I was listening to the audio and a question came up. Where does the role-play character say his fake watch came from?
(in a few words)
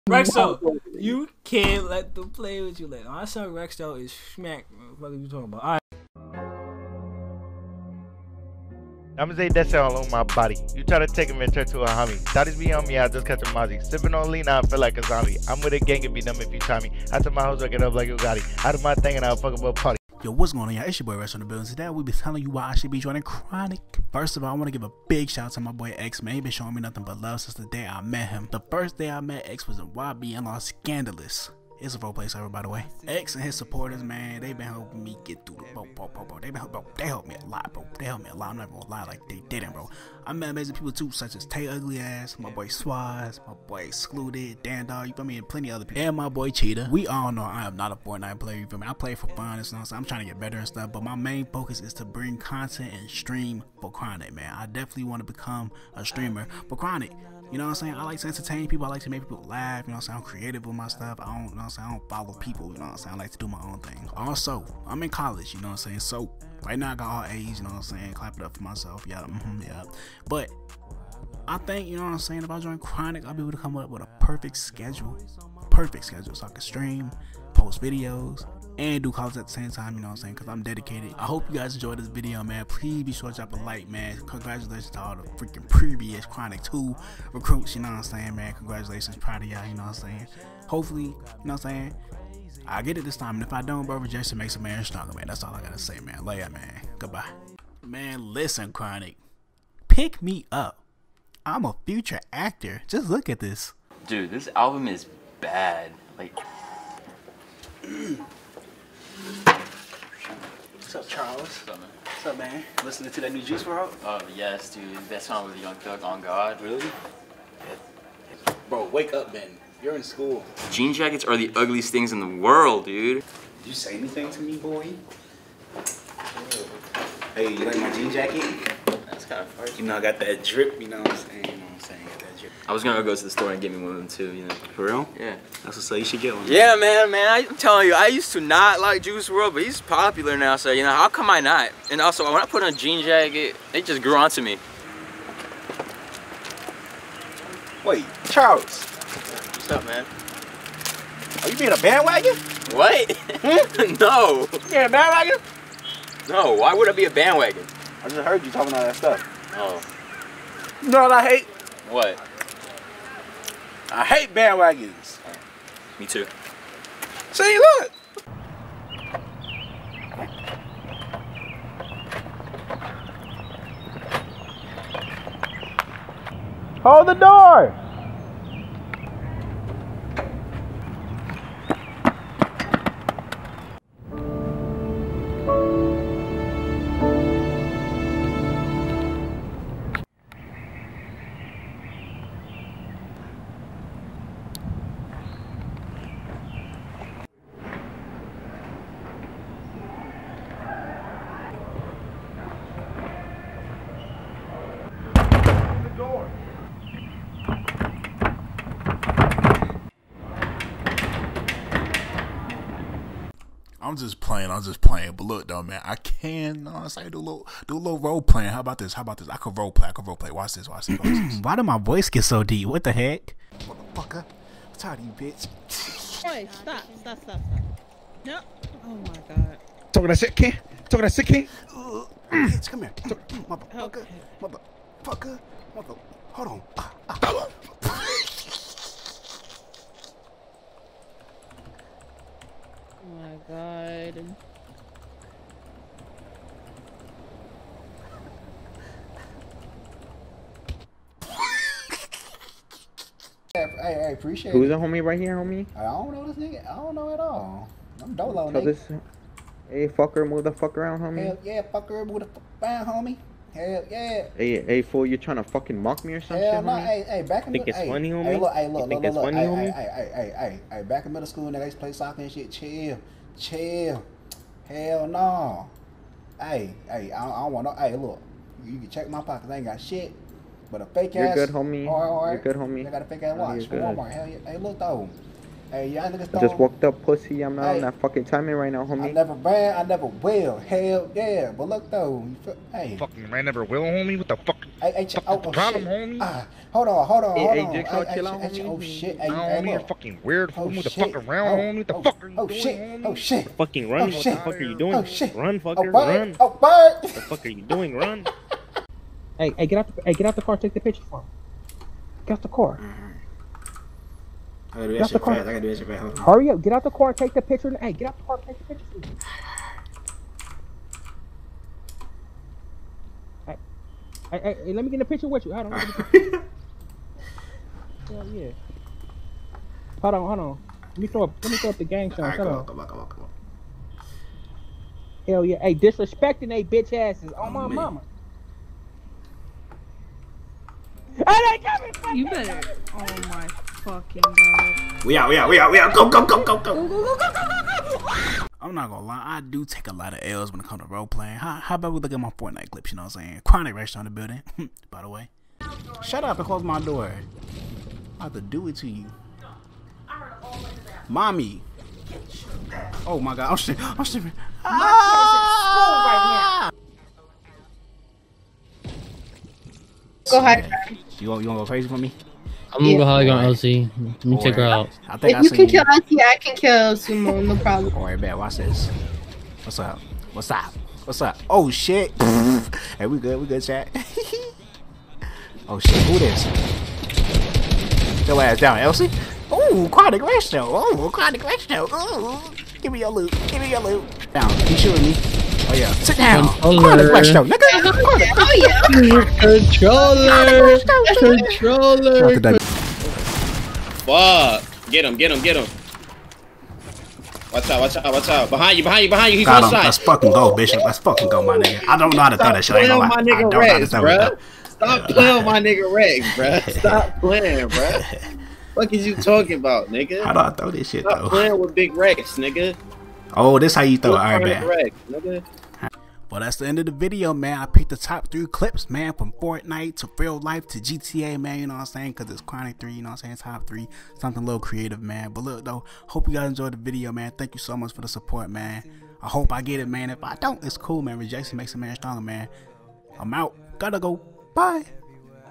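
Walmart.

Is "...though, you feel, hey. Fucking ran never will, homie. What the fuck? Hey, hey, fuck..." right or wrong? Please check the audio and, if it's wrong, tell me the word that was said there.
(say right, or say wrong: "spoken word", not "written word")
right.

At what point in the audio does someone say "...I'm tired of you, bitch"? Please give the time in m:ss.
3:44.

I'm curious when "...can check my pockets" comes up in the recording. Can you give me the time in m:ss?
4:38.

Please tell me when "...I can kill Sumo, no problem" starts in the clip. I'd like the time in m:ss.
6:16.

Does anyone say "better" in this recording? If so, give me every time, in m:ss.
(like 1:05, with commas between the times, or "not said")
0:50, 5:42.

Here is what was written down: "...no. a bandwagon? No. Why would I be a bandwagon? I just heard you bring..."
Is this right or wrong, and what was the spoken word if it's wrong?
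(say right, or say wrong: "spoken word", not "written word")
wrong: "talking", not "bring".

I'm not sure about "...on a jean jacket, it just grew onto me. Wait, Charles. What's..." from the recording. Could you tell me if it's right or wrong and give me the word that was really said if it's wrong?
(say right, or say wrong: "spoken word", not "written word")
right.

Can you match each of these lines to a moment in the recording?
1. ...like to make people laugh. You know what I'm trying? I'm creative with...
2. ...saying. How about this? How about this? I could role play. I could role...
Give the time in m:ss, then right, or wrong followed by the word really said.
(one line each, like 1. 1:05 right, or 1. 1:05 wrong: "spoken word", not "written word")
1. 0:58 wrong: "saying", not "trying"
2. 3:38 wrong: "playing", not "saying".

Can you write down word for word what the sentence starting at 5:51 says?
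How, how about we look at my Fortnite clips, you know what I'm saying?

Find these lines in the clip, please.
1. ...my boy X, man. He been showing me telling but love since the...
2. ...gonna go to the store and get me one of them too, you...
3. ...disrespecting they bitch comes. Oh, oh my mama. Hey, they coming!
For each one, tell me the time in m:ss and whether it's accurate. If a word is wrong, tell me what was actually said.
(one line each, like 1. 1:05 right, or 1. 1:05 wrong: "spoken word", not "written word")
1. 0:25 wrong: "nothing", not "telling"
2. 2:12 right
3. 5:35 wrong: "asses", not "comes".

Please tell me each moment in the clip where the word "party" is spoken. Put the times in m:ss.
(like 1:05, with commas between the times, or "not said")
0:19.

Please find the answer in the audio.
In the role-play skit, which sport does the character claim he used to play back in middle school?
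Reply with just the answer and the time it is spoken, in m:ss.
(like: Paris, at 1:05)
Soccer, at 4:31.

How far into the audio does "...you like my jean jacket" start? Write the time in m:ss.
2:07.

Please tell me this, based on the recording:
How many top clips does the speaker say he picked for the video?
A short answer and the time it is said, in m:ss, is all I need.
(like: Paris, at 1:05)
3, at 7:08.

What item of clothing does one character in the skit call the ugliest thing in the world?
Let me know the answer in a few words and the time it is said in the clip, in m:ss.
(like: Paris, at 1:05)
Jean jackets, at 2:00.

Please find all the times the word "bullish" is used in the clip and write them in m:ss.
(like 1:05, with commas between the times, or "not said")
not said.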